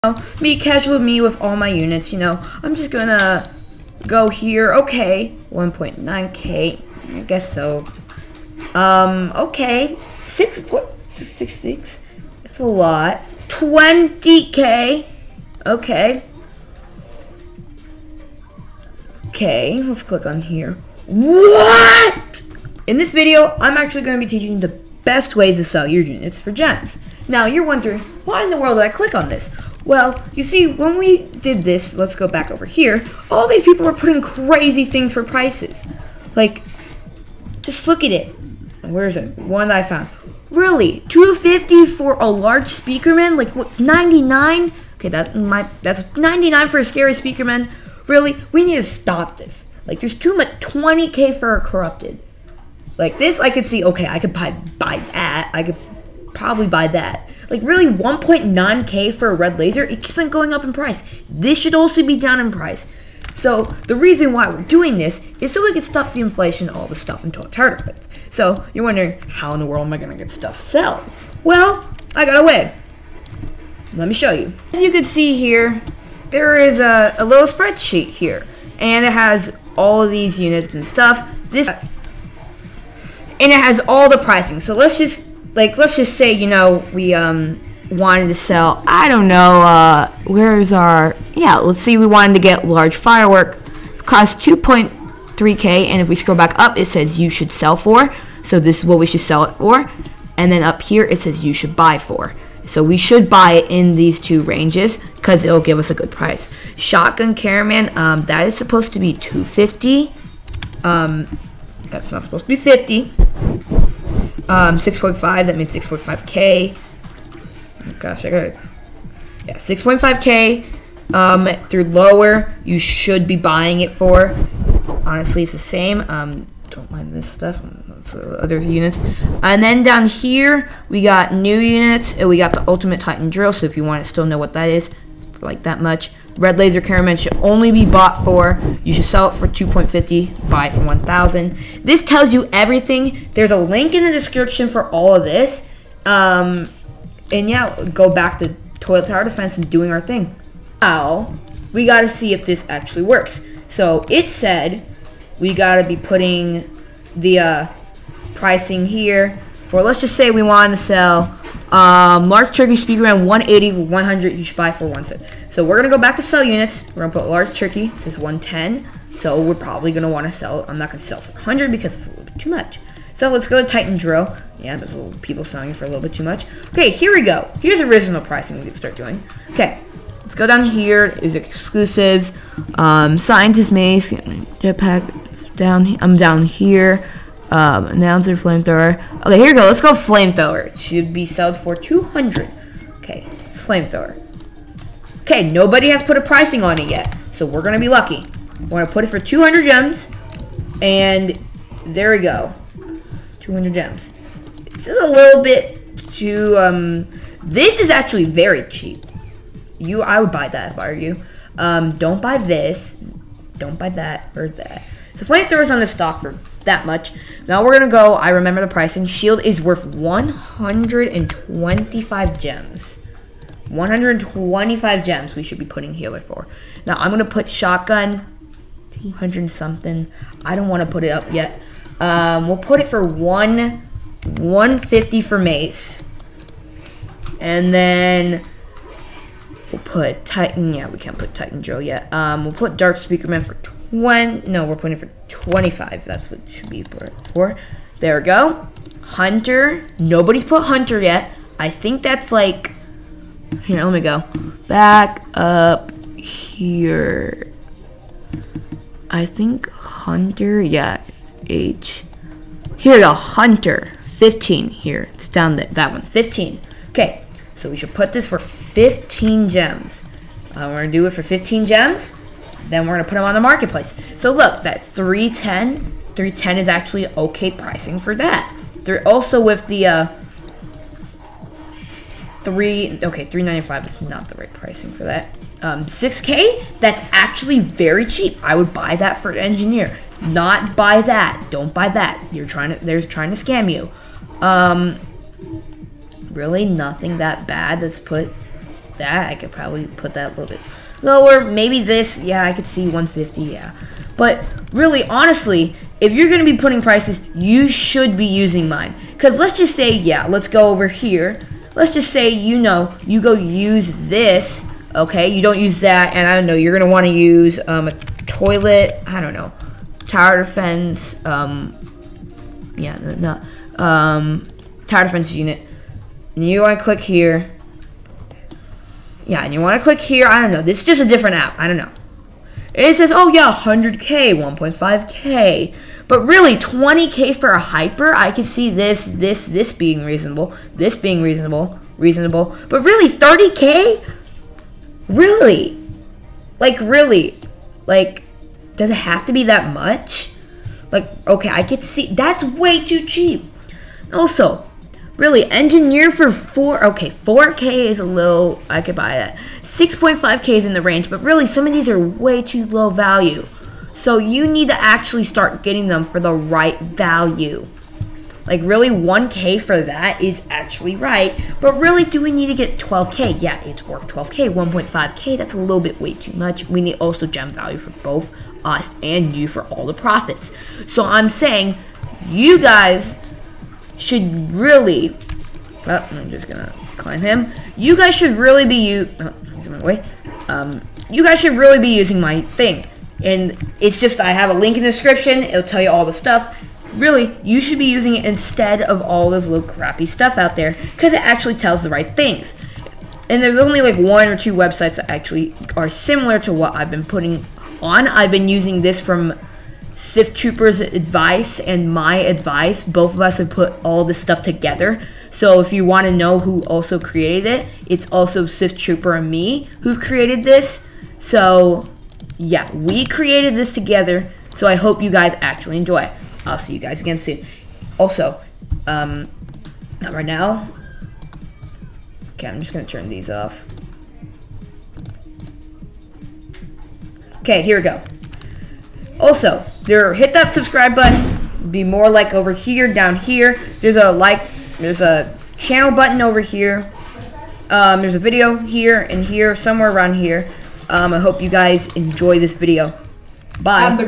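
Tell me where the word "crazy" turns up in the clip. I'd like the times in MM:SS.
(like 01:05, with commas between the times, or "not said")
00:34.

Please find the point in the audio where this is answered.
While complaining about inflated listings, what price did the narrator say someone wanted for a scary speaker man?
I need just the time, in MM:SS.
00:46.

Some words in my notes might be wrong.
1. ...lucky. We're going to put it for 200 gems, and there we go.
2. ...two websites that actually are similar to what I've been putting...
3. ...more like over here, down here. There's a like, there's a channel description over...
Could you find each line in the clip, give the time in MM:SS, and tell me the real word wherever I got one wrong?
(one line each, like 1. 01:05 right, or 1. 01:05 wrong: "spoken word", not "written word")
1. 03:17 right
2. 06:44 right
3. 07:21 wrong: "button", not "description".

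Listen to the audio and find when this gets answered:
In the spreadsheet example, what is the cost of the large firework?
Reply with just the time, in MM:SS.
01:34.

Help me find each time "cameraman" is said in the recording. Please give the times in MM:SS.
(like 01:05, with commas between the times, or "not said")
01:47, 02:16.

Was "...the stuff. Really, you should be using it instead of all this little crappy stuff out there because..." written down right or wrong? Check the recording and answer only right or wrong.
right.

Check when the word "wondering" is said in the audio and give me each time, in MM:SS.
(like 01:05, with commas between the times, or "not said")
00:27, 01:08.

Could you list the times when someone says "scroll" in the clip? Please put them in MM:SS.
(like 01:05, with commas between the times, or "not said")
01:36.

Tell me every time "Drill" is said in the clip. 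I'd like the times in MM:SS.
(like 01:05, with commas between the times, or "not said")
02:13, 02:53.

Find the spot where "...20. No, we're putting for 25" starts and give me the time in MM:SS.
04:03.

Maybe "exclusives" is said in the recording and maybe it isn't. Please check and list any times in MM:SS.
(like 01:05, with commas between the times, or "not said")
03:01.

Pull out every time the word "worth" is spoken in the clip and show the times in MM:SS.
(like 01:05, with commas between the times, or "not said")
03:39, 06:13.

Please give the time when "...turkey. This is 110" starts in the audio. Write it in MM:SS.
02:47.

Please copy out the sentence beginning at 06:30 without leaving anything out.
Um, you guys should really be using my thing.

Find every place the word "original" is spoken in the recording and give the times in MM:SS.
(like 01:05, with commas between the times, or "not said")
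02:57.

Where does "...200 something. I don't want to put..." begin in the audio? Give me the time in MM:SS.
03:48.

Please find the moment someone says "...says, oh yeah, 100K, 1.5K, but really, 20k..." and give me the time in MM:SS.
05:32.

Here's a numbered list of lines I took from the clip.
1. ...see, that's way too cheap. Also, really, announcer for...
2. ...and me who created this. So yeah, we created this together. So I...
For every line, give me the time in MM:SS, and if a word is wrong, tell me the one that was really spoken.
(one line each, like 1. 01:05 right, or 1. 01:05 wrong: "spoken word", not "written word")
1. 05:51 wrong: "engineer", not "announcer"
2. 06:59 right.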